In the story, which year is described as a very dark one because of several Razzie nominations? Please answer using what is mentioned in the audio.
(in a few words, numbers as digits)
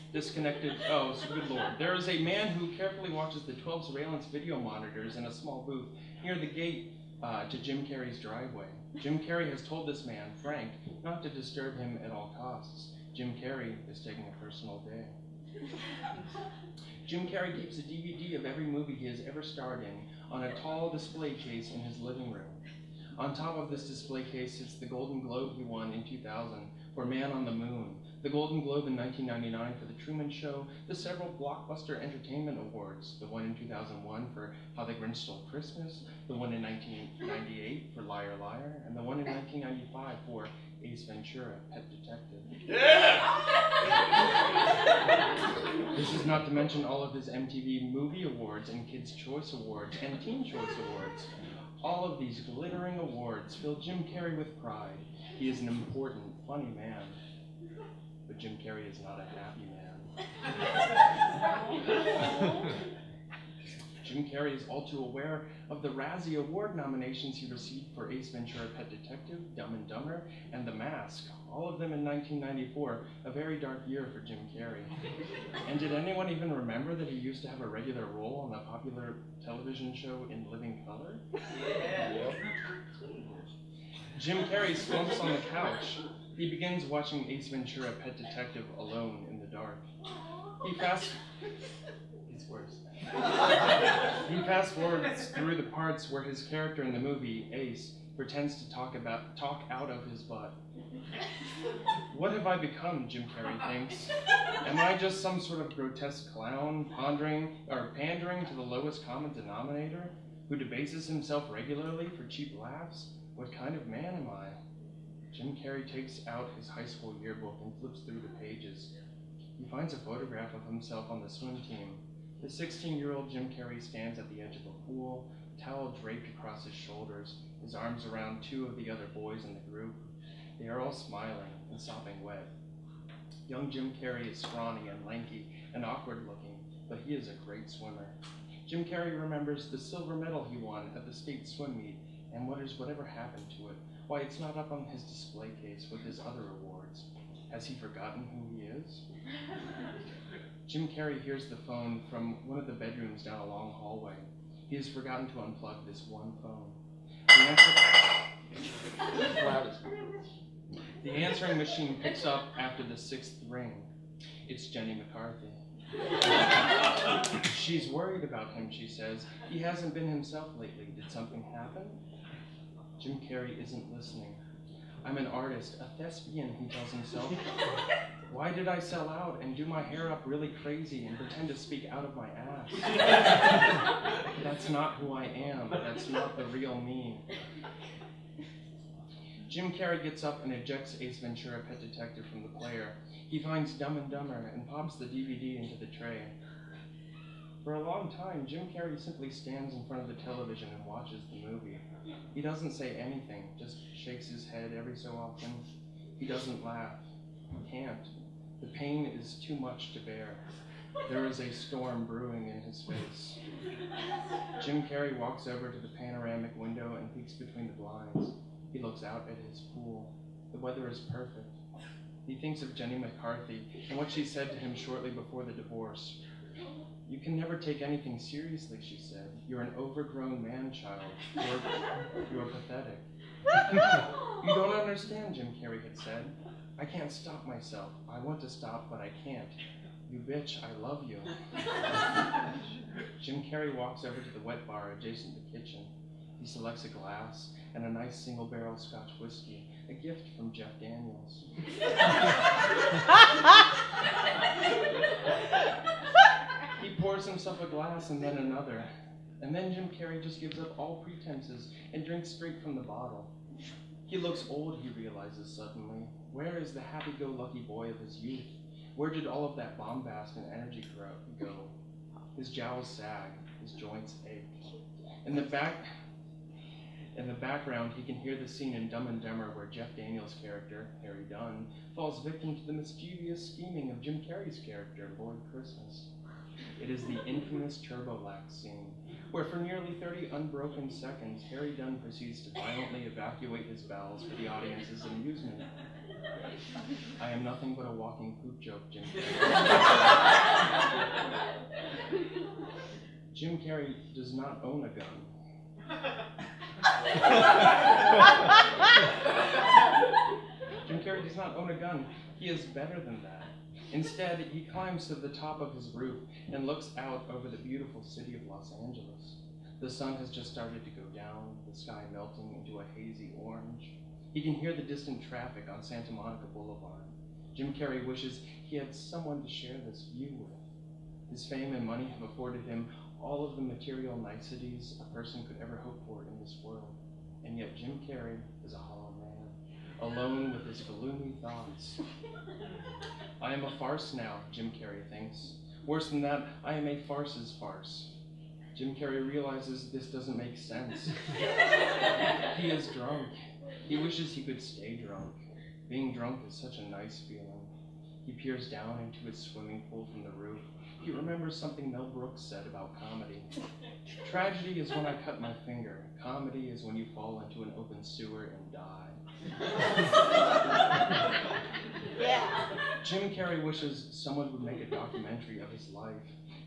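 1994.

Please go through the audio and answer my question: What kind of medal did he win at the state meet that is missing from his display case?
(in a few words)
silver.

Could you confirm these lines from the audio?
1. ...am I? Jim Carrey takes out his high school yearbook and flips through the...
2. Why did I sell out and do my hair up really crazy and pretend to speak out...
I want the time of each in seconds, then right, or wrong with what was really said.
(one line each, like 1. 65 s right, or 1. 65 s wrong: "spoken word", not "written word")
1. 114 s right
2. 178 s right.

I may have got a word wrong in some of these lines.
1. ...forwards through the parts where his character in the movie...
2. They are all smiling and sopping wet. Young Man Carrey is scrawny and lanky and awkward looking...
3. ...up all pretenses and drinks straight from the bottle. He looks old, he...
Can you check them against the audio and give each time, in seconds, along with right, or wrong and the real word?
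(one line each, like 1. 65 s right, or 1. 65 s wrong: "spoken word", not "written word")
1. 94 s right
2. 130 s wrong: "Jim", not "Man"
3. 260 s right.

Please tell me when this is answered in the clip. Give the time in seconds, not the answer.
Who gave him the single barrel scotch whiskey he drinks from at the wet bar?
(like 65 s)
250 s.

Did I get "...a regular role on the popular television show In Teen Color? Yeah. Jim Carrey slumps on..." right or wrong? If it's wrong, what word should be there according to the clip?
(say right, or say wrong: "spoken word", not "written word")
wrong: "Living", not "Teen".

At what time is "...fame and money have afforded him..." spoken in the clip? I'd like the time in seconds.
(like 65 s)
331 s.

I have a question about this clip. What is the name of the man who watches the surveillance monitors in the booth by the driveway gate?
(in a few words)
Frank.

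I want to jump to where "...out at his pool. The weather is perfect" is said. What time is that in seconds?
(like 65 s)
219 s.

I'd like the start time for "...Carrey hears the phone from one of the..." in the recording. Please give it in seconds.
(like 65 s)
150 s.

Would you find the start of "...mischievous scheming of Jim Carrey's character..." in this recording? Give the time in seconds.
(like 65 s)
282 s.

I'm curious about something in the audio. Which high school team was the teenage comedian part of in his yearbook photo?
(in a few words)
swim team.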